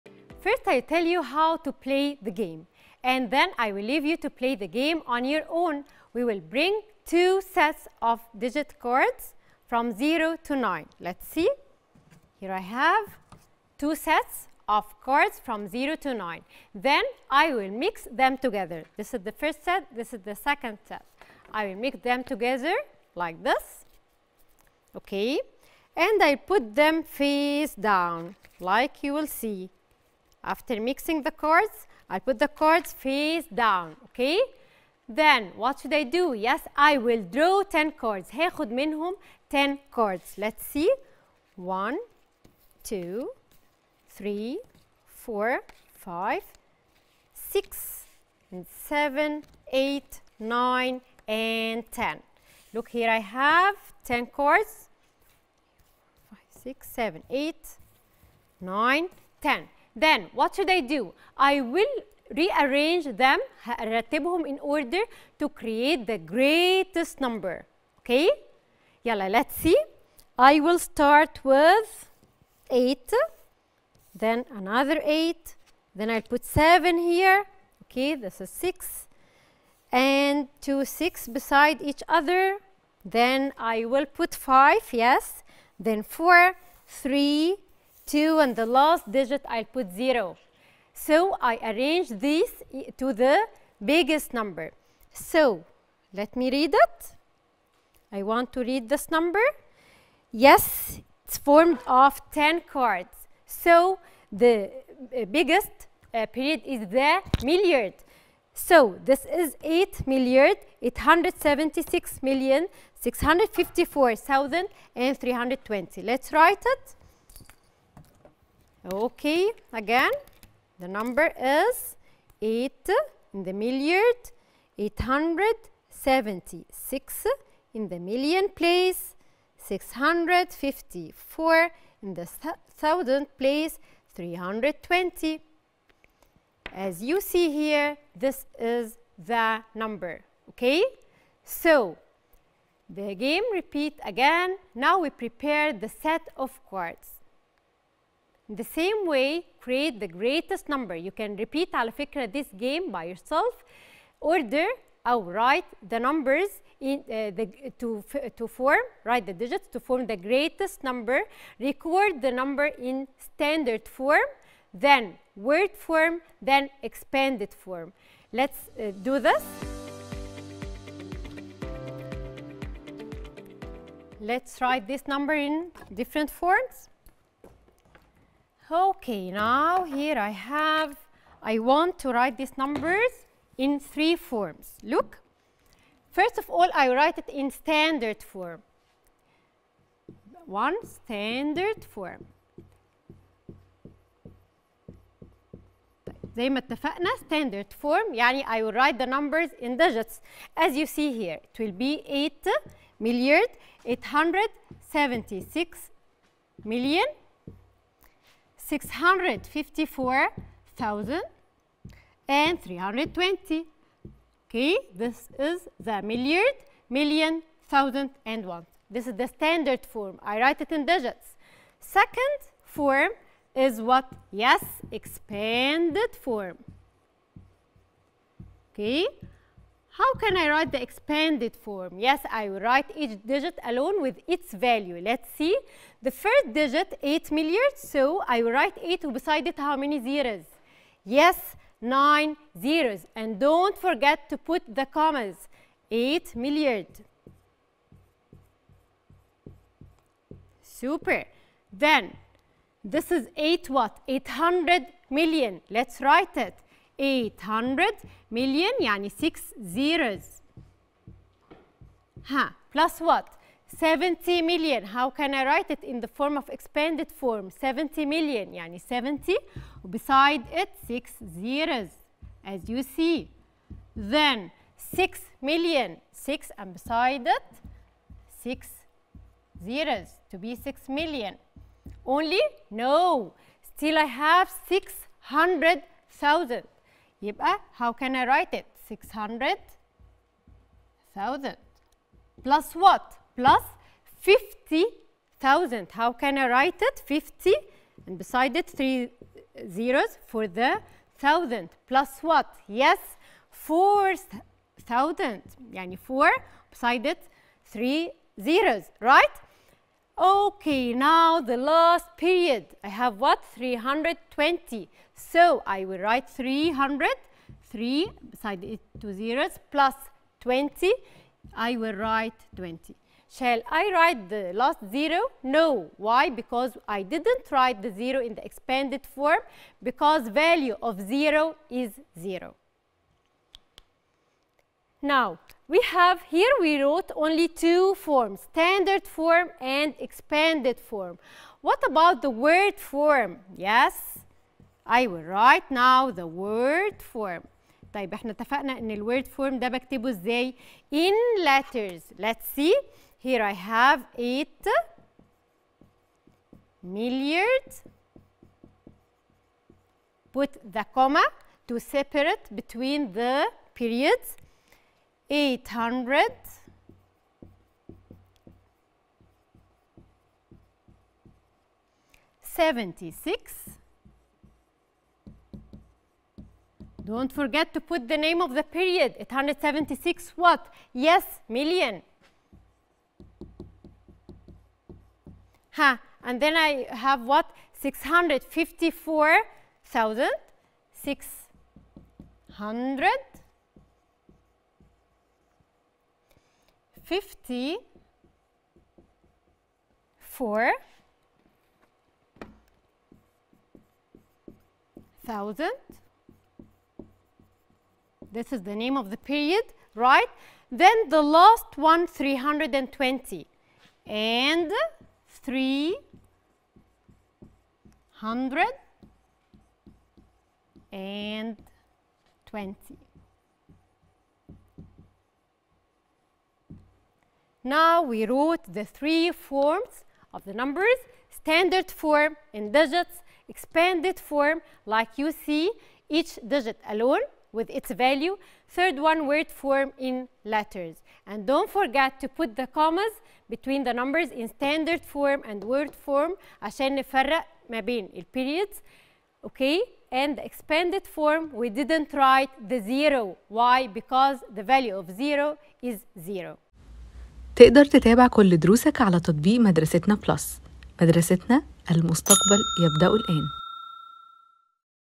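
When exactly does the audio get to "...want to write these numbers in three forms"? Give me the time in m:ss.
3:01.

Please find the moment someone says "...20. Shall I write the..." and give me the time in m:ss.
5:22.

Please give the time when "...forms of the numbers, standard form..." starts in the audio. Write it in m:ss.
7:09.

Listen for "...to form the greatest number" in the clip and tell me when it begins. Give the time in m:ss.
2:39.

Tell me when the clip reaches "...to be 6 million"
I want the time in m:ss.
4:40.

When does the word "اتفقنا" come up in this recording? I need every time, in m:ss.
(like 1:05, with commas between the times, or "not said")
3:16, 5:48.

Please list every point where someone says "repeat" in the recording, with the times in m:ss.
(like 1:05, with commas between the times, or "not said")
2:23, 2:31.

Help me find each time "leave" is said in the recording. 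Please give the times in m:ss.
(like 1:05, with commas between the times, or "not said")
0:03.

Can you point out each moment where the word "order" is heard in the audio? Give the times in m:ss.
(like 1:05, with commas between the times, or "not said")
1:04, 2:34.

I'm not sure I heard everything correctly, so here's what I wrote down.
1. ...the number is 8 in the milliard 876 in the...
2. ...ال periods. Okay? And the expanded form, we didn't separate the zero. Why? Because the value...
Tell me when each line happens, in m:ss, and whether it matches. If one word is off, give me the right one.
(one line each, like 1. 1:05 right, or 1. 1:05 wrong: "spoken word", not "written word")
1. 2:00 right
2. 7:28 wrong: "write", not "separate".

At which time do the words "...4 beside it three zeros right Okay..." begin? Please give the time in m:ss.
5:05.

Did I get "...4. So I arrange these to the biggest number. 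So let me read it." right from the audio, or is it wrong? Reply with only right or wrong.
wrong.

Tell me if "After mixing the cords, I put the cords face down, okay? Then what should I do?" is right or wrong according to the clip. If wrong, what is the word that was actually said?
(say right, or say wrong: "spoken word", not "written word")
right.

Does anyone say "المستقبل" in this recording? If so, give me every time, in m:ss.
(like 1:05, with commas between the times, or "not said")
7:41.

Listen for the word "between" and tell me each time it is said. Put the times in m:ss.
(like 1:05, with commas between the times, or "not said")
6:02, 7:23.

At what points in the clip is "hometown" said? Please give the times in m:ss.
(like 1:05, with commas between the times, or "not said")
not said.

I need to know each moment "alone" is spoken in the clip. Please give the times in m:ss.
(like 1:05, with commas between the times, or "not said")
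3:53, 7:16.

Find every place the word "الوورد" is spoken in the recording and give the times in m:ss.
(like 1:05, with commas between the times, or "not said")
5:48.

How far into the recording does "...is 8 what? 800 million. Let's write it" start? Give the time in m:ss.
4:13.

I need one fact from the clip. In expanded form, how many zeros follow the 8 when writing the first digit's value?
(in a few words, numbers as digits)
9.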